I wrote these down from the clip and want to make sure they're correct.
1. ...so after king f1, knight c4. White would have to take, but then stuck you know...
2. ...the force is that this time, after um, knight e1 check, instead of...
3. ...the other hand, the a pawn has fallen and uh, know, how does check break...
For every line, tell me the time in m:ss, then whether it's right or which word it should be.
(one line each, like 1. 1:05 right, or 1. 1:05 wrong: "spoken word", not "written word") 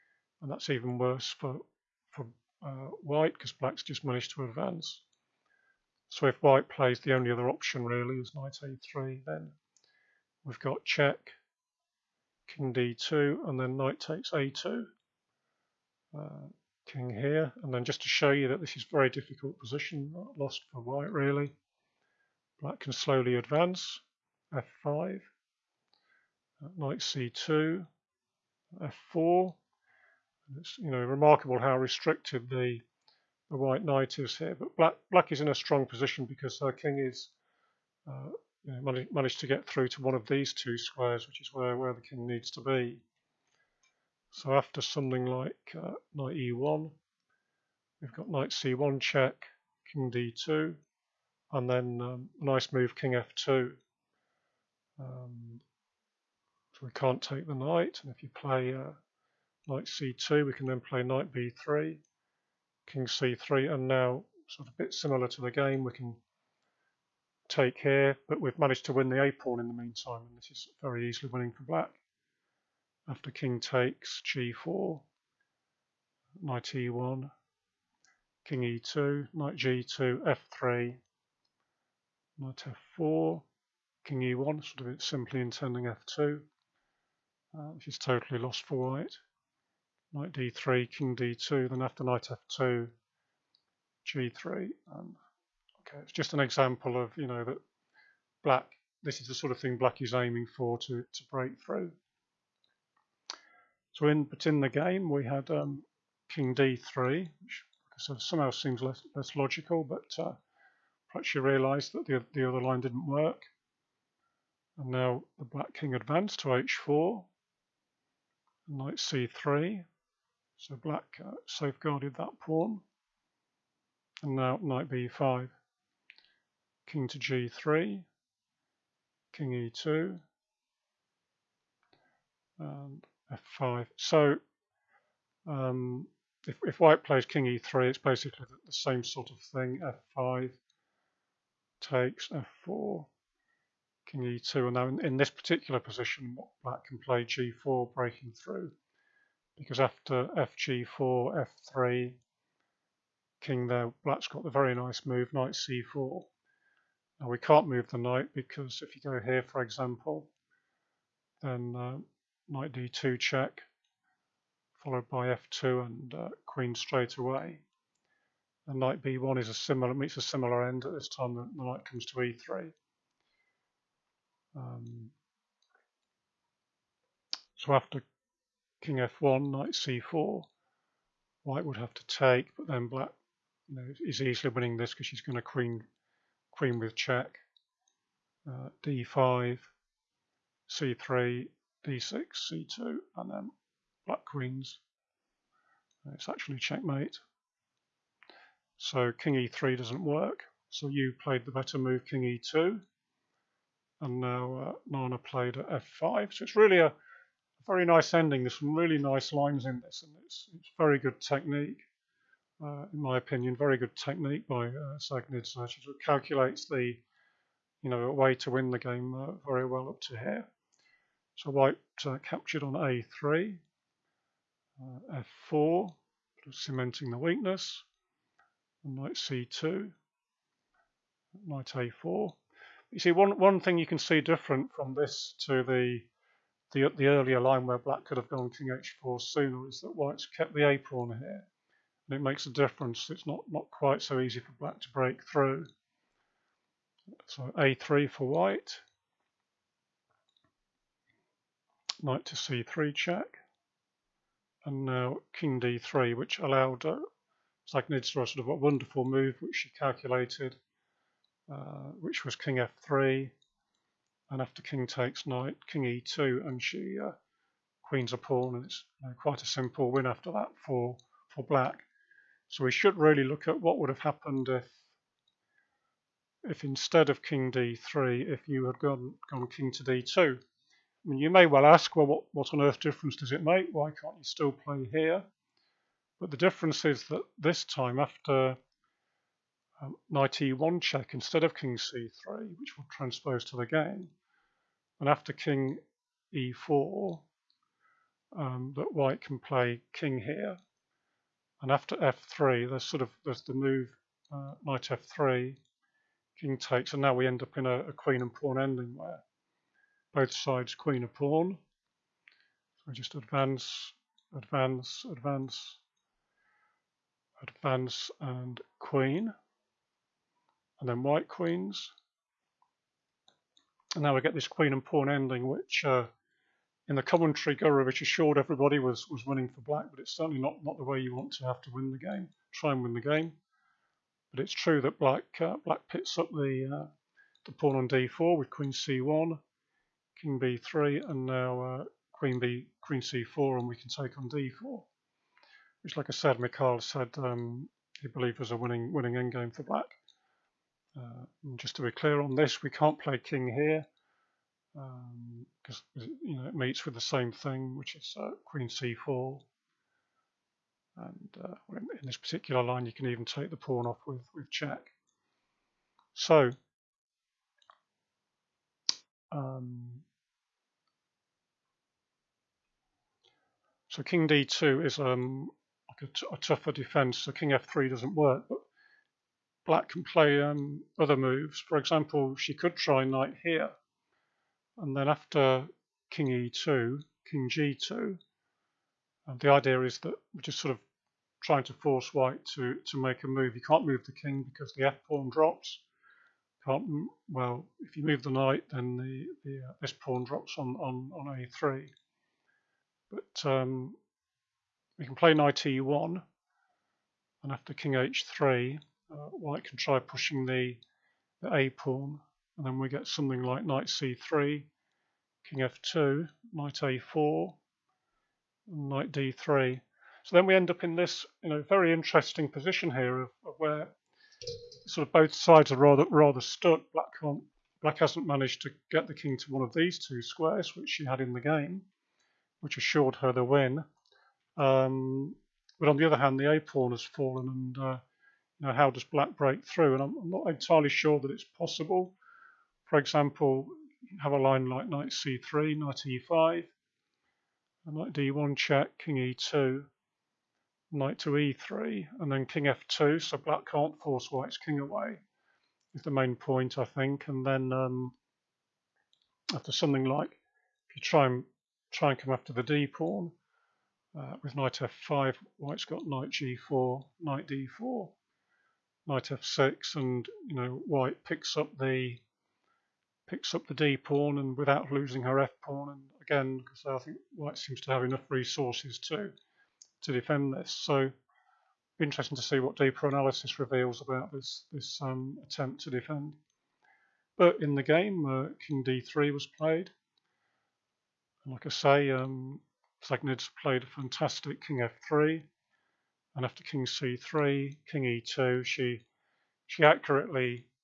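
1. 2:57 wrong: "black", not "stuck"
2. 4:46 wrong: "difference", not "force"
3. 7:15 wrong: "black", not "check".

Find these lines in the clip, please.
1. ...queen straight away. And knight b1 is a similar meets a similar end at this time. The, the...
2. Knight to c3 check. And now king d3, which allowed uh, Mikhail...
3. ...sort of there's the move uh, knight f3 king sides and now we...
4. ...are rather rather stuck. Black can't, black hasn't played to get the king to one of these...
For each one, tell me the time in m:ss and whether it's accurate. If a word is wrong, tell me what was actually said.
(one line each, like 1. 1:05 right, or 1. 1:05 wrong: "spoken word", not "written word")
1. 2:46 right
2. 4:12 wrong: "Dzagnidze", not "Mikhail"
3. 5:02 wrong: "takes", not "sides"
4. 7:05 wrong: "managed", not "played".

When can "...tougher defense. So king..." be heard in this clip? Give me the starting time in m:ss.
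6:16.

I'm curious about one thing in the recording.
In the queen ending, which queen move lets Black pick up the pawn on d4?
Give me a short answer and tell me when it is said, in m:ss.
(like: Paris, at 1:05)
Queen c1, at 5:38.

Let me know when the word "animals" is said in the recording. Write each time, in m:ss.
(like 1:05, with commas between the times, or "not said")
not said.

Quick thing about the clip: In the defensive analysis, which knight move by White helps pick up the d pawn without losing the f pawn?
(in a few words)
Knight g4.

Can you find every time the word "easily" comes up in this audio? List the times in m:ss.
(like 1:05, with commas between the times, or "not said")
1:11, 3:04.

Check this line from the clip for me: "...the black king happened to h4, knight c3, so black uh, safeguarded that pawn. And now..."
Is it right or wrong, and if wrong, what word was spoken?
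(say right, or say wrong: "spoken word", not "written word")
wrong: "advanced", not "happened".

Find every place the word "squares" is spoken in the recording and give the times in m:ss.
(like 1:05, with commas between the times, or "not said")
0:40, 7:10.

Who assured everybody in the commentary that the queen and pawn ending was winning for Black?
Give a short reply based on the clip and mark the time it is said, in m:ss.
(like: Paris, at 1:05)
Gurevich, at 5:27.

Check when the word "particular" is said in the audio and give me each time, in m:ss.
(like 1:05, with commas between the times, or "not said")
2:25, 6:02.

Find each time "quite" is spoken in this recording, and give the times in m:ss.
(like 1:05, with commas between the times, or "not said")
4:03, 4:29.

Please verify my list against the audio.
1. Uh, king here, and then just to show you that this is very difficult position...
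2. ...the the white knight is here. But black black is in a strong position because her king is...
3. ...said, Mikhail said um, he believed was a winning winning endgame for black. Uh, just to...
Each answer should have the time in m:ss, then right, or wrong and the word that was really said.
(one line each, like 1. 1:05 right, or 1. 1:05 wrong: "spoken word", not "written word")
1. 0:16 right
2. 0:32 right
3. 5:46 right.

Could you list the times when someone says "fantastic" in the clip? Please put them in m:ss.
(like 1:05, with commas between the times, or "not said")
8:13.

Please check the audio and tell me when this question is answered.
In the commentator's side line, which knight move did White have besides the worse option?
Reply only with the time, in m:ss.
0:08.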